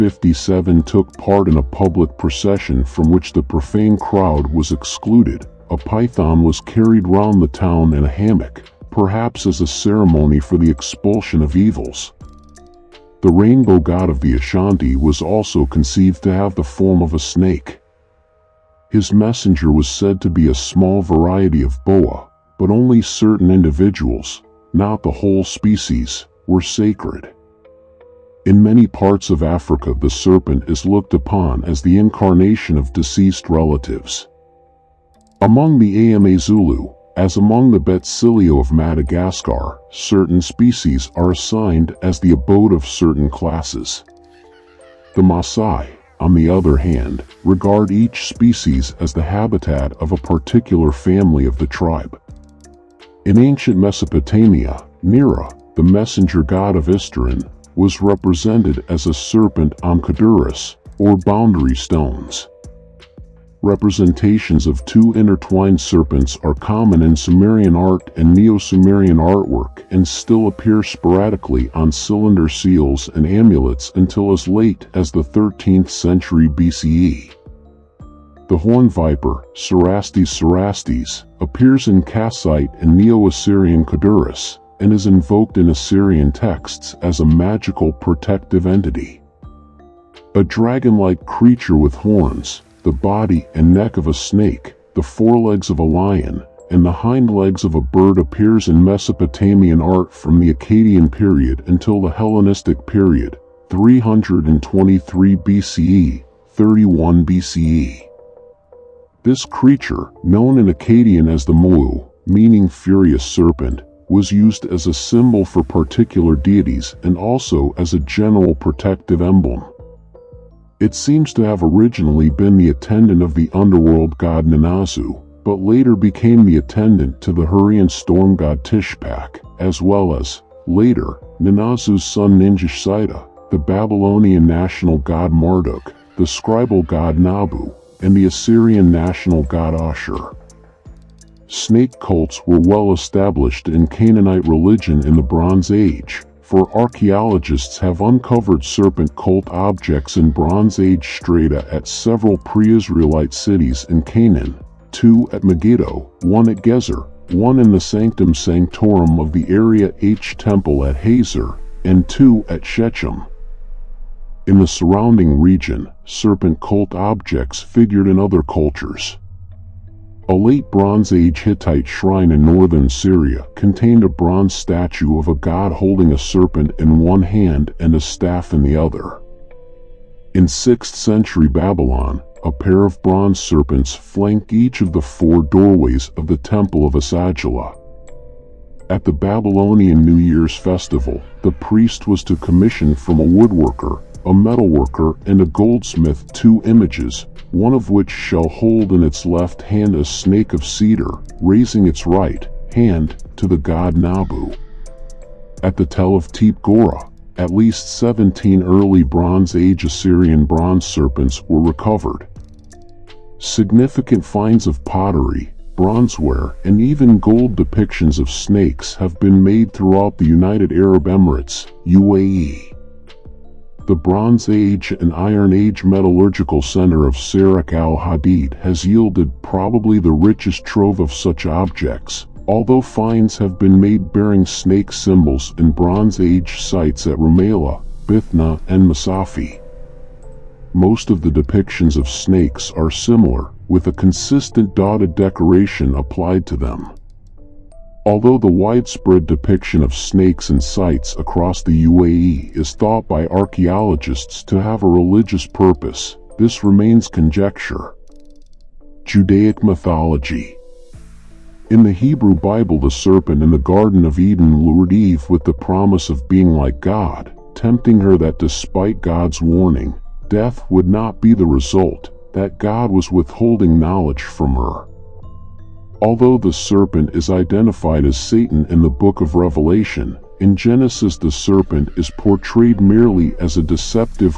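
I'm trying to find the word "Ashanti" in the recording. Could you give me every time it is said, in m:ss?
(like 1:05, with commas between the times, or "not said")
0:14.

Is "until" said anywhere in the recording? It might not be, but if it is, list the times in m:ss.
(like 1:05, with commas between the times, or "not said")
1:13, 1:41.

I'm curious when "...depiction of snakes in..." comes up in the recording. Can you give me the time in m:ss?
4:09.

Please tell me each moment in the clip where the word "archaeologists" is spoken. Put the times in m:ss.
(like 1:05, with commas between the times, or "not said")
2:26, 4:13.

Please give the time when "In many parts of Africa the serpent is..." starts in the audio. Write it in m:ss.
0:28.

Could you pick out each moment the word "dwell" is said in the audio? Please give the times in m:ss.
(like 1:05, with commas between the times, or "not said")
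not said.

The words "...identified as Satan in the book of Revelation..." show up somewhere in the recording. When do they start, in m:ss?
4:37.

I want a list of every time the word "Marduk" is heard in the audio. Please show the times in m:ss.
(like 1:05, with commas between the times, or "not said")
2:15.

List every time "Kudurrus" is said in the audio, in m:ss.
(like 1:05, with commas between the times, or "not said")
1:00, 1:23.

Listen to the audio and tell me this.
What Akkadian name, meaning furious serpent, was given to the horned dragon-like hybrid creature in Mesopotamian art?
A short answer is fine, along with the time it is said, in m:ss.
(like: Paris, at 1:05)
mulu, at 1:51.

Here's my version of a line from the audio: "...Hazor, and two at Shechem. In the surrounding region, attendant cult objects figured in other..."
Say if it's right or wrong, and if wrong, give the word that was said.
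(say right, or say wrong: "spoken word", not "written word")
wrong: "serpent", not "attendant".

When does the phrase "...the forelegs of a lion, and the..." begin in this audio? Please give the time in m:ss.
1:34.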